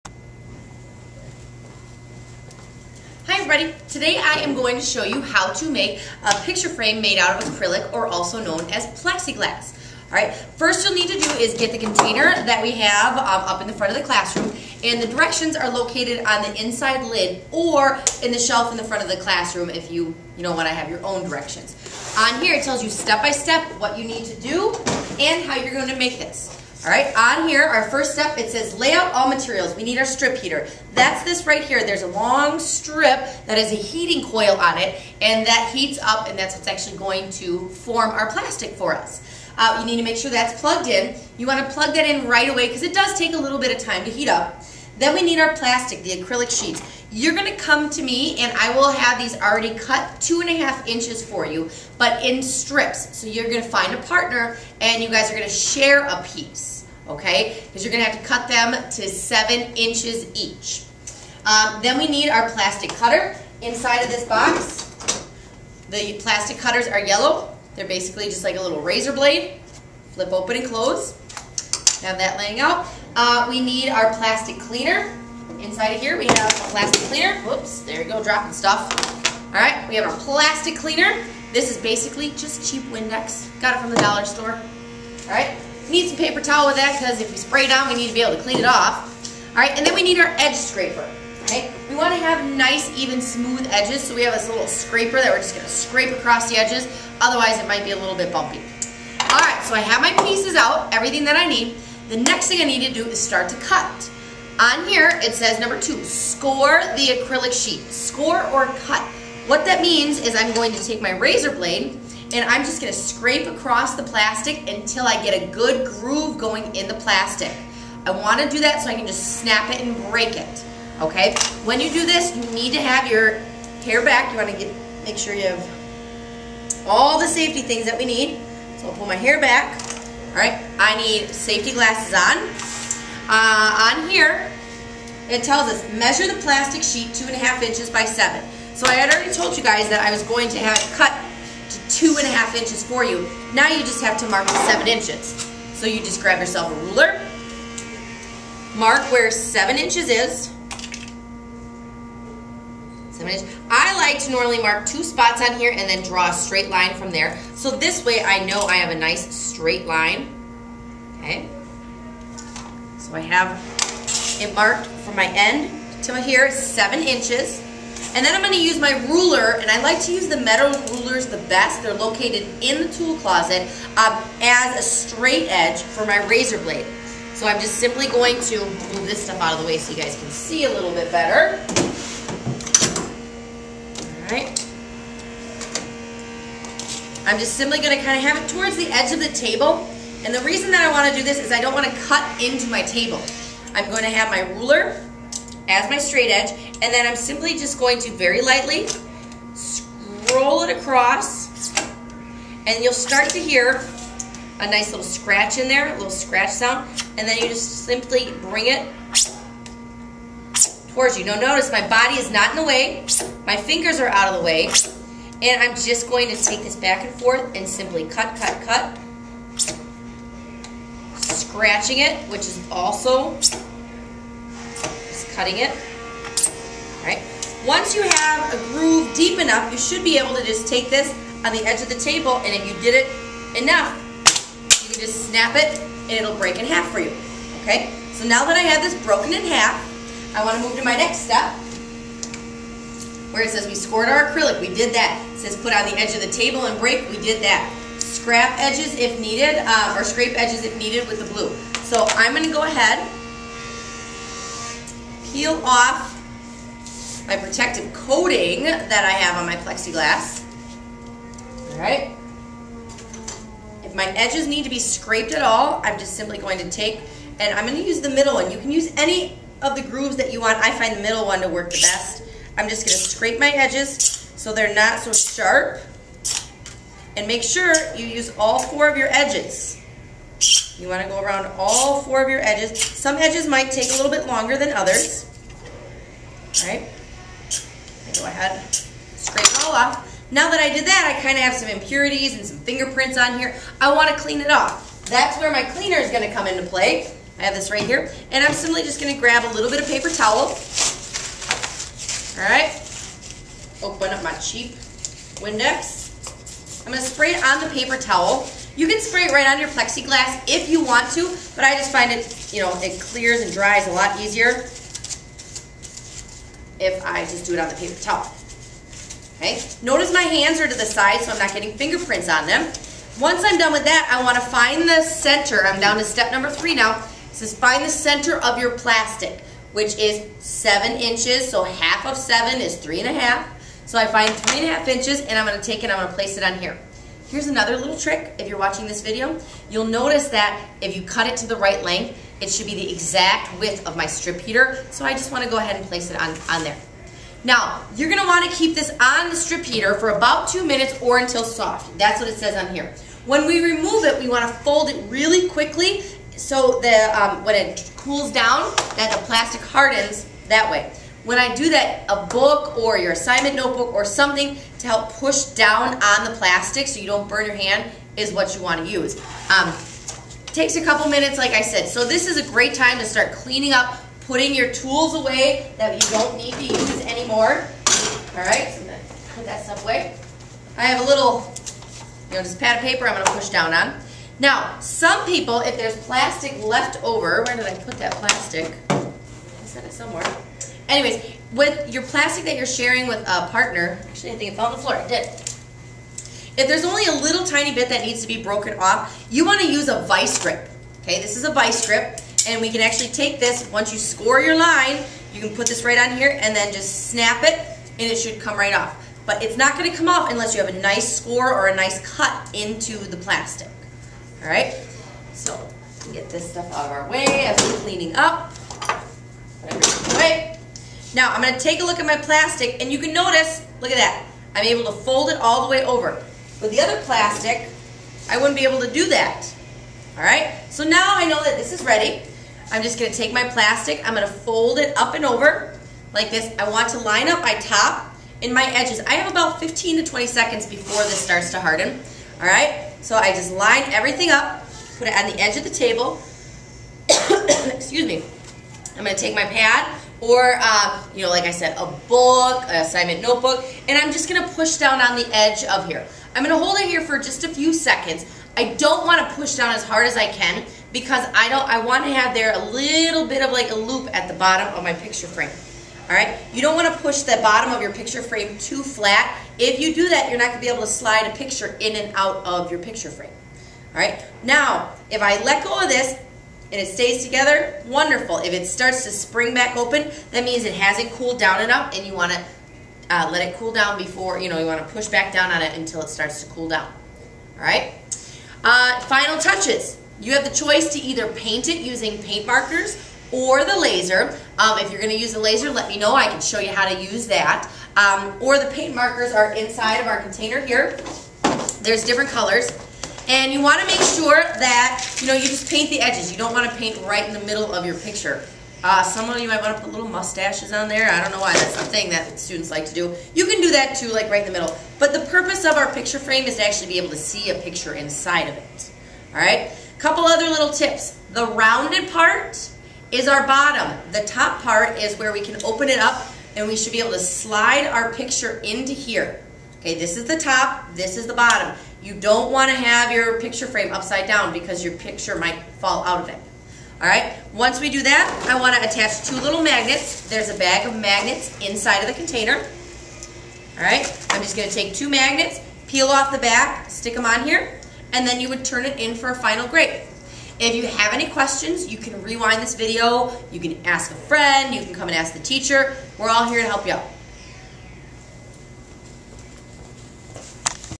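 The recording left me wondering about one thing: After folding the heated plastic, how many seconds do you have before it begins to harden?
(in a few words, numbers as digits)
15 to 20 seconds.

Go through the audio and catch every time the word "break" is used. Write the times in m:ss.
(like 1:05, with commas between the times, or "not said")
2:00, 3:56, 4:06.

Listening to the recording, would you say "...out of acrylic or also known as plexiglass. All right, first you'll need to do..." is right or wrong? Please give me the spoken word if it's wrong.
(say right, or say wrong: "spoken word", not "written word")
right.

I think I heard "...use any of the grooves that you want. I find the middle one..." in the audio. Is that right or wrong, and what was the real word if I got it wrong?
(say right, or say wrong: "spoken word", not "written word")
right.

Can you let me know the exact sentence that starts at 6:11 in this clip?
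So this is a great time to start cleaning up, putting your tools away that you don't need to use anymore.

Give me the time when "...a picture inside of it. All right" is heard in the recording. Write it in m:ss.
8:37.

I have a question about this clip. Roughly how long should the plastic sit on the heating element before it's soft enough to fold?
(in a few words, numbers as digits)
2 minutes.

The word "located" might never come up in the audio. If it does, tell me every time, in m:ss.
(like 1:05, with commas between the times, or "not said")
0:15, 2:51.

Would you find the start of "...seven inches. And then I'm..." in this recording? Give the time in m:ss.
2:46.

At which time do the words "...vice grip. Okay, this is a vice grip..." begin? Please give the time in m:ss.
6:40.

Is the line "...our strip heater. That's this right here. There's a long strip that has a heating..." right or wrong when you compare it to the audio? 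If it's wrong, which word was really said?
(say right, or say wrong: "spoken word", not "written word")
right.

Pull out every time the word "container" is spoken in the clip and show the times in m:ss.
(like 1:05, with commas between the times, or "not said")
0:11, 8:20, 9:02.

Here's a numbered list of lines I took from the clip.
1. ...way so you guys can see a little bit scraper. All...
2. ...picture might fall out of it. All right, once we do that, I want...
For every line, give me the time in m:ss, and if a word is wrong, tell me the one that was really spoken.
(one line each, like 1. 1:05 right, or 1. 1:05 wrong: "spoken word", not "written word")
1. 2:59 wrong: "better", not "scraper"
2. 8:54 right.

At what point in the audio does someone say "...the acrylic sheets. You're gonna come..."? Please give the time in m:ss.
0:46.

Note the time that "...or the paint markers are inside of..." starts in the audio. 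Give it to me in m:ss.
8:18.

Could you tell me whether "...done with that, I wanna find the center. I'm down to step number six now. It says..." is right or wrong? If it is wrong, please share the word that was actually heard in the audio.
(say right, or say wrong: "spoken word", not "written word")
wrong: "three", not "six".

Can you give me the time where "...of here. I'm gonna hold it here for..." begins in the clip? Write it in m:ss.
7:35.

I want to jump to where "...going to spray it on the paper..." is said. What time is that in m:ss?
5:06.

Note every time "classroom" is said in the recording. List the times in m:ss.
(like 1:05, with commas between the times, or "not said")
0:14, 0:19.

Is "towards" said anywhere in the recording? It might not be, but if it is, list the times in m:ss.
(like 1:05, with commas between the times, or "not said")
3:08, 3:30.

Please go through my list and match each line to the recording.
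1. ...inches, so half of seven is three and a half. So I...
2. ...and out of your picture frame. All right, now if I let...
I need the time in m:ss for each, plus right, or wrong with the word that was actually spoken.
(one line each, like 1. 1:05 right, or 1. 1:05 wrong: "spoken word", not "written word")
1. 5:30 right
2. 7:51 right.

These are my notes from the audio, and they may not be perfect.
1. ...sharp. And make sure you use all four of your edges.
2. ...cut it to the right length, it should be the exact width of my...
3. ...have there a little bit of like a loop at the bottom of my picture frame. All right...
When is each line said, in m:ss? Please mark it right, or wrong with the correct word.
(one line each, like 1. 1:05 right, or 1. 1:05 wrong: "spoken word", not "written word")
1. 4:35 right
2. 5:41 right
3. 7:42 right.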